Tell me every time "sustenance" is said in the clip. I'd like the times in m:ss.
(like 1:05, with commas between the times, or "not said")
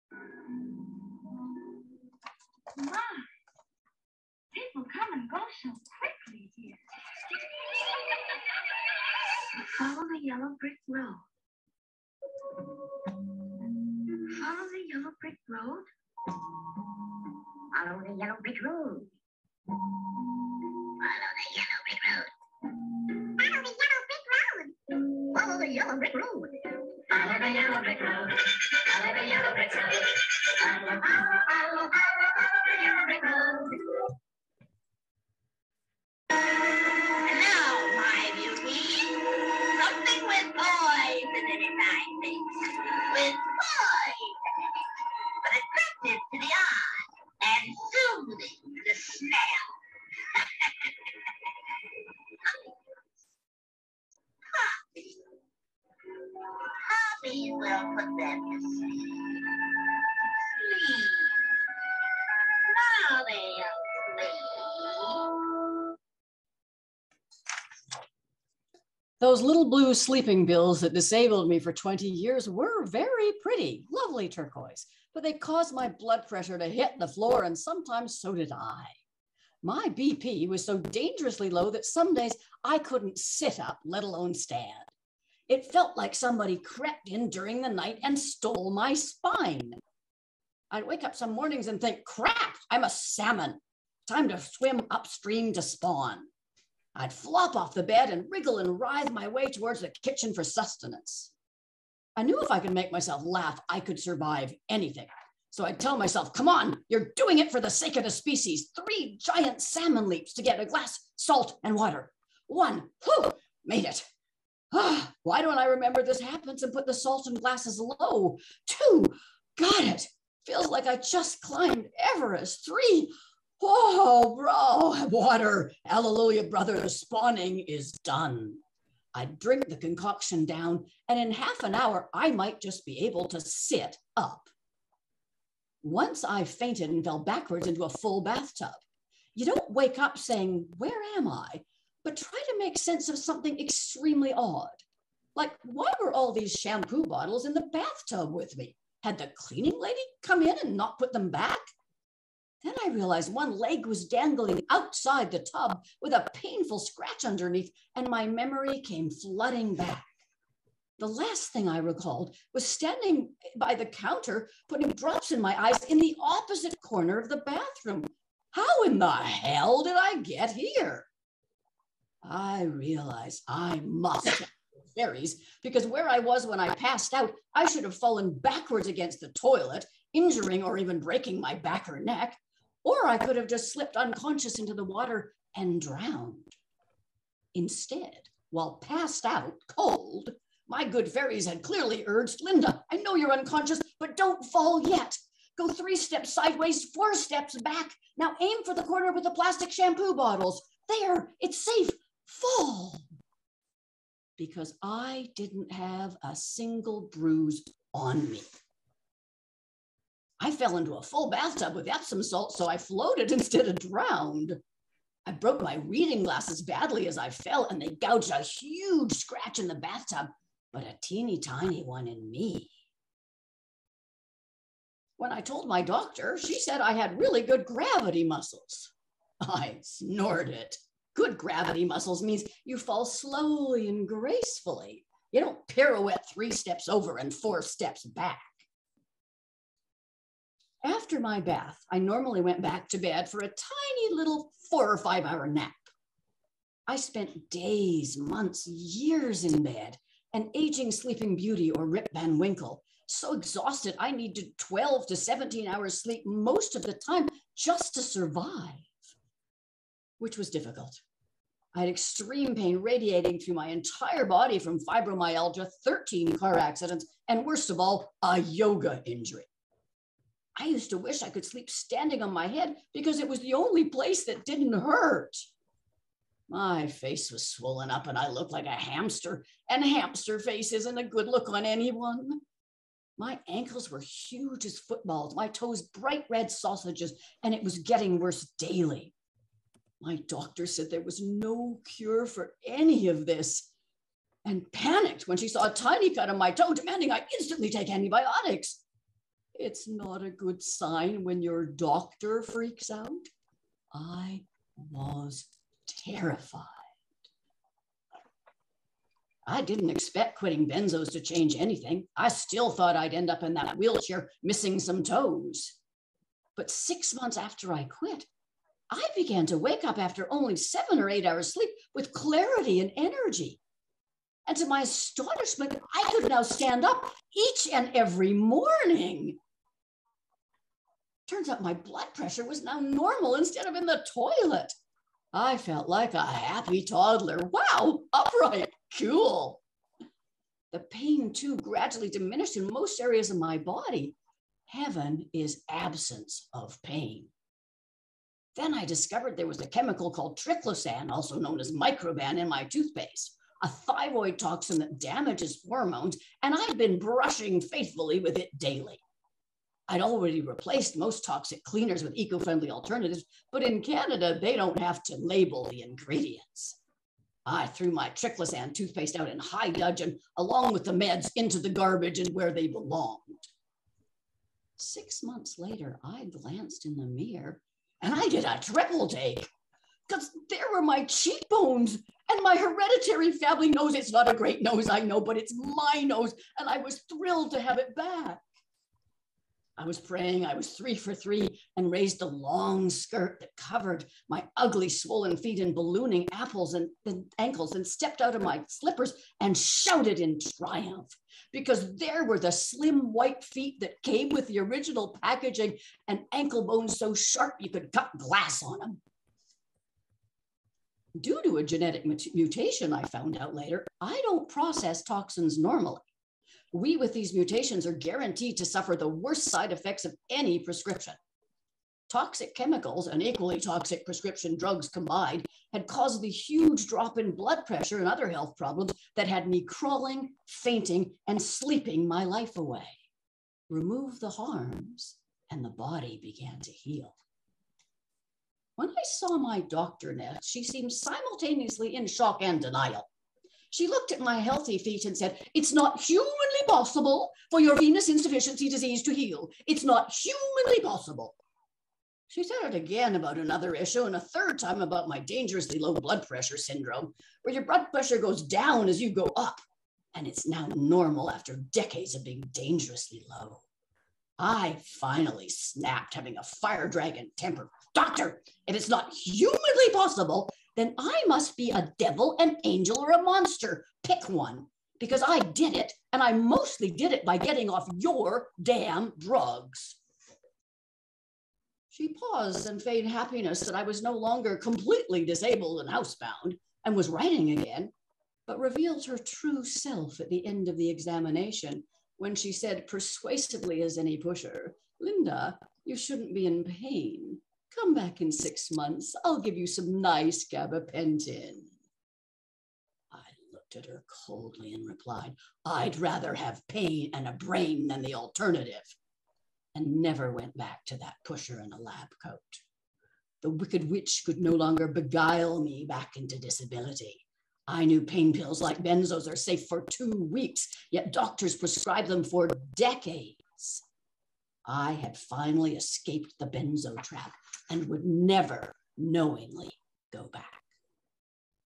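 1:40.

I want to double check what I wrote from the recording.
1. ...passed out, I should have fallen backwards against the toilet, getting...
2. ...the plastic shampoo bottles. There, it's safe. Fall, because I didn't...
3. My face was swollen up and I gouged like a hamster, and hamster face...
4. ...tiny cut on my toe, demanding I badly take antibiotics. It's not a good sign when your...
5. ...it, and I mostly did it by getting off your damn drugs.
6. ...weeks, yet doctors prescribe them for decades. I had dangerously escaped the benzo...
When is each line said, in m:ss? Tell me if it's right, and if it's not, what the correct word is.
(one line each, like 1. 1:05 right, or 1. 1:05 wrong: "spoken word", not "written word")
1. 2:56 wrong: "injuring", not "getting"
2. 3:19 right
3. 4:36 wrong: "looked", not "gouged"
4. 4:55 wrong: "instantly", not "badly"
5. 7:55 right
6. 8:40 wrong: "finally", not "dangerously".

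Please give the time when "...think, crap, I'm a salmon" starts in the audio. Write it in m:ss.
1:31.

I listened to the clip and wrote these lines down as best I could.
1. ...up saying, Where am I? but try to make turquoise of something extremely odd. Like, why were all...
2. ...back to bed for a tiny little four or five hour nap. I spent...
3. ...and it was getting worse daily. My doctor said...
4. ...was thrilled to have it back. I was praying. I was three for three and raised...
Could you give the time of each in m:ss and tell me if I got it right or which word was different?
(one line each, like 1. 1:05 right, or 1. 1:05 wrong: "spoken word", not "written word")
1. 2:19 wrong: "sense", not "turquoise"
2. 4:02 right
3. 4:47 right
4. 6:26 right.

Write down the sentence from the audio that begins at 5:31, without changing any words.
Turns out my blood pressure was now normal instead of in the toilet.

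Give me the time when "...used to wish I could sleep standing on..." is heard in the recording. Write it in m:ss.
4:30.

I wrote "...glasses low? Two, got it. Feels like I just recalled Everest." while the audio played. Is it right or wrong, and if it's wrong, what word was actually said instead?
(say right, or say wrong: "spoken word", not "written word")
wrong: "climbed", not "recalled".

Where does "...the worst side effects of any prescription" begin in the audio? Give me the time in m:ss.
6:58.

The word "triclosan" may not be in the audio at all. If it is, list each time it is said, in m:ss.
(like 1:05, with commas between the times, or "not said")
5:50, 6:08.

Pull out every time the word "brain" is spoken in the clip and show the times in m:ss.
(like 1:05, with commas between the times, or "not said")
8:27.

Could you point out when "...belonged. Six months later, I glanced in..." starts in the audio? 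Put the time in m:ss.
6:12.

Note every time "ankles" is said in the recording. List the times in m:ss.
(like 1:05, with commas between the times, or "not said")
4:43, 6:37, 6:46.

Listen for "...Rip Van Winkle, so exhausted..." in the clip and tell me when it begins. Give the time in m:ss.
4:11.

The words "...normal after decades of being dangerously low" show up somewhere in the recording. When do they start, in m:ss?
7:40.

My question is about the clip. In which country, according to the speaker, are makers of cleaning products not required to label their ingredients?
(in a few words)
Canada.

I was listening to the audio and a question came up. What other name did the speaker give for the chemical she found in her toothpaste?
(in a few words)
microban.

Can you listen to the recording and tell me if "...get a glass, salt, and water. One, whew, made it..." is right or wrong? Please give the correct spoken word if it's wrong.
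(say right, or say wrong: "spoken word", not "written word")
right.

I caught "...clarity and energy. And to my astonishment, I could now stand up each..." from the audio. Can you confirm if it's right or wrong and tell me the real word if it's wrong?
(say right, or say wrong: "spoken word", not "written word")
right.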